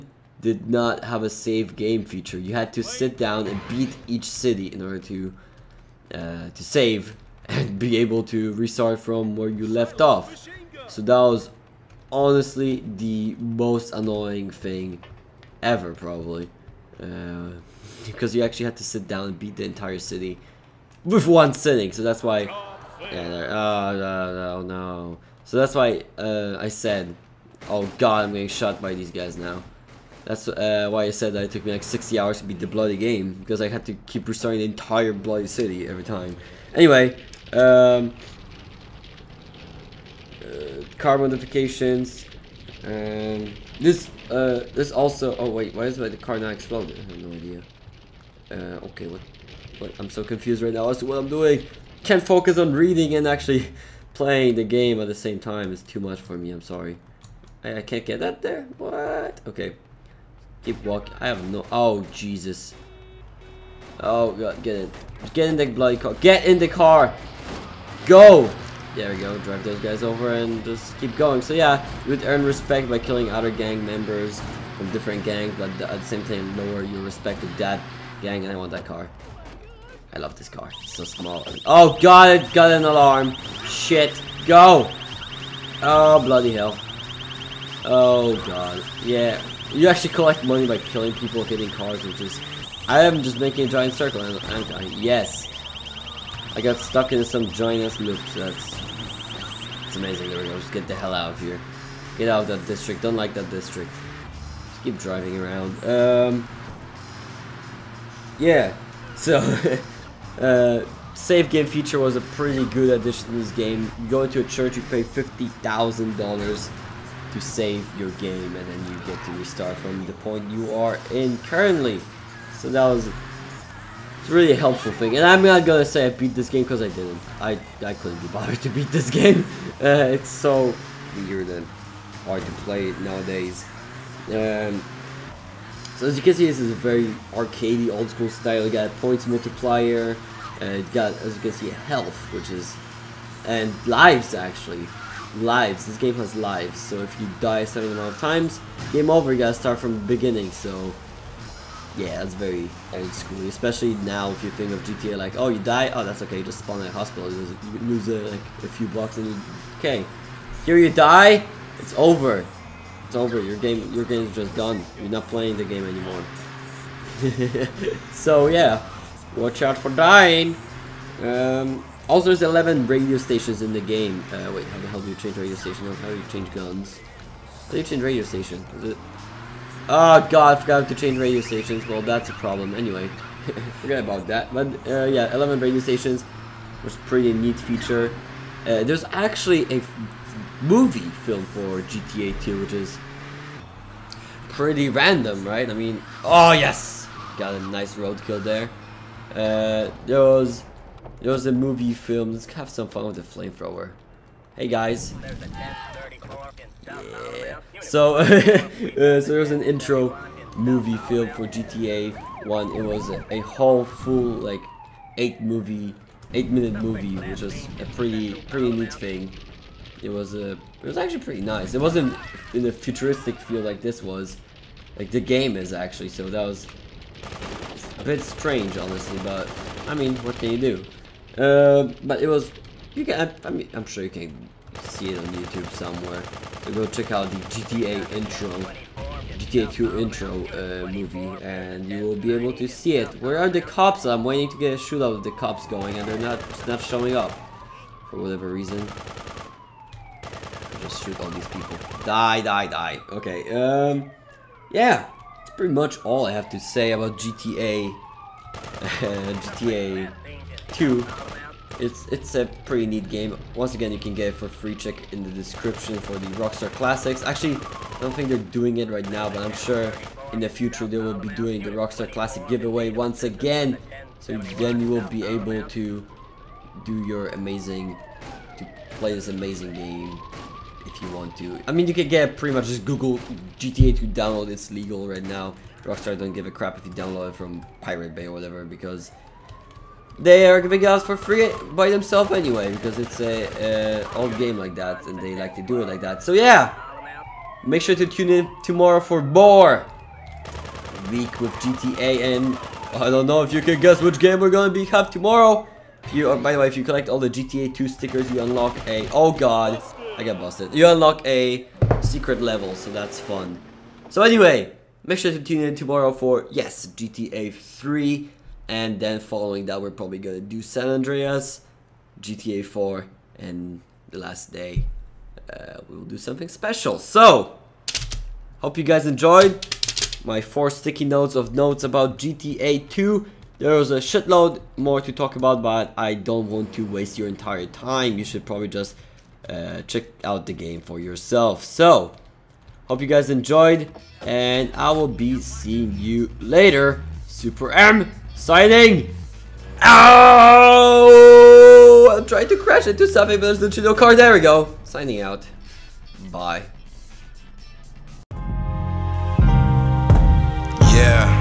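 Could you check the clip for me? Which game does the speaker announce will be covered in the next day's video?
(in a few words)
GTA 3.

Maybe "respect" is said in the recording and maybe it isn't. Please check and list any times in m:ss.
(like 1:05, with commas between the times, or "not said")
1:12, 1:17.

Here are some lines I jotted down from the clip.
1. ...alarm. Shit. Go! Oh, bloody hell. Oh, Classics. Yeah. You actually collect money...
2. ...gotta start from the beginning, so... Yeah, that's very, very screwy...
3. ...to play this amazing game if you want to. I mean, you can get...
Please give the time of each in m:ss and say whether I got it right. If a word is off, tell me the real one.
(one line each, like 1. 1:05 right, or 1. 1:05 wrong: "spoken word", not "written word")
1. 1:22 wrong: "God", not "Classics"
2. 2:29 right
3. 4:38 right.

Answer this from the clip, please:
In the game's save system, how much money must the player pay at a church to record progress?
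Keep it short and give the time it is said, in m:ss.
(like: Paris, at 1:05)
$50,000, at 1:55.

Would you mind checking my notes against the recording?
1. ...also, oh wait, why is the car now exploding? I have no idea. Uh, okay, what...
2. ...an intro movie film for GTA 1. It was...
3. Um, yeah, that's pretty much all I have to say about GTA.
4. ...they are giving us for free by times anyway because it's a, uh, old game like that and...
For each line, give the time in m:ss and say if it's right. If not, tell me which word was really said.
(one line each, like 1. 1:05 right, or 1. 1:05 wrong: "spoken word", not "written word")
1. 0:44 right
2. 3:29 right
3. 4:13 right
4. 4:50 wrong: "themselves", not "times".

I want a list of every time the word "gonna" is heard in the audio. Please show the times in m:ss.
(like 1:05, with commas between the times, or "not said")
2:05, 5:04, 5:20.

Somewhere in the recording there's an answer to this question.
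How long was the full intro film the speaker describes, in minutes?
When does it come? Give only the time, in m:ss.
3:36.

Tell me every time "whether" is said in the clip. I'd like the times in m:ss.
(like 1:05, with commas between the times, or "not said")
not said.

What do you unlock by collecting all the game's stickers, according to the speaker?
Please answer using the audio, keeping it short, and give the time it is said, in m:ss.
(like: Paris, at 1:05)
A secret level, at 5:12.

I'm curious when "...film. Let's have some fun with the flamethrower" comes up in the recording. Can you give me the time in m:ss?
3:21.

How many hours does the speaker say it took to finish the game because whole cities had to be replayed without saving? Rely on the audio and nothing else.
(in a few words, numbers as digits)
60 hours.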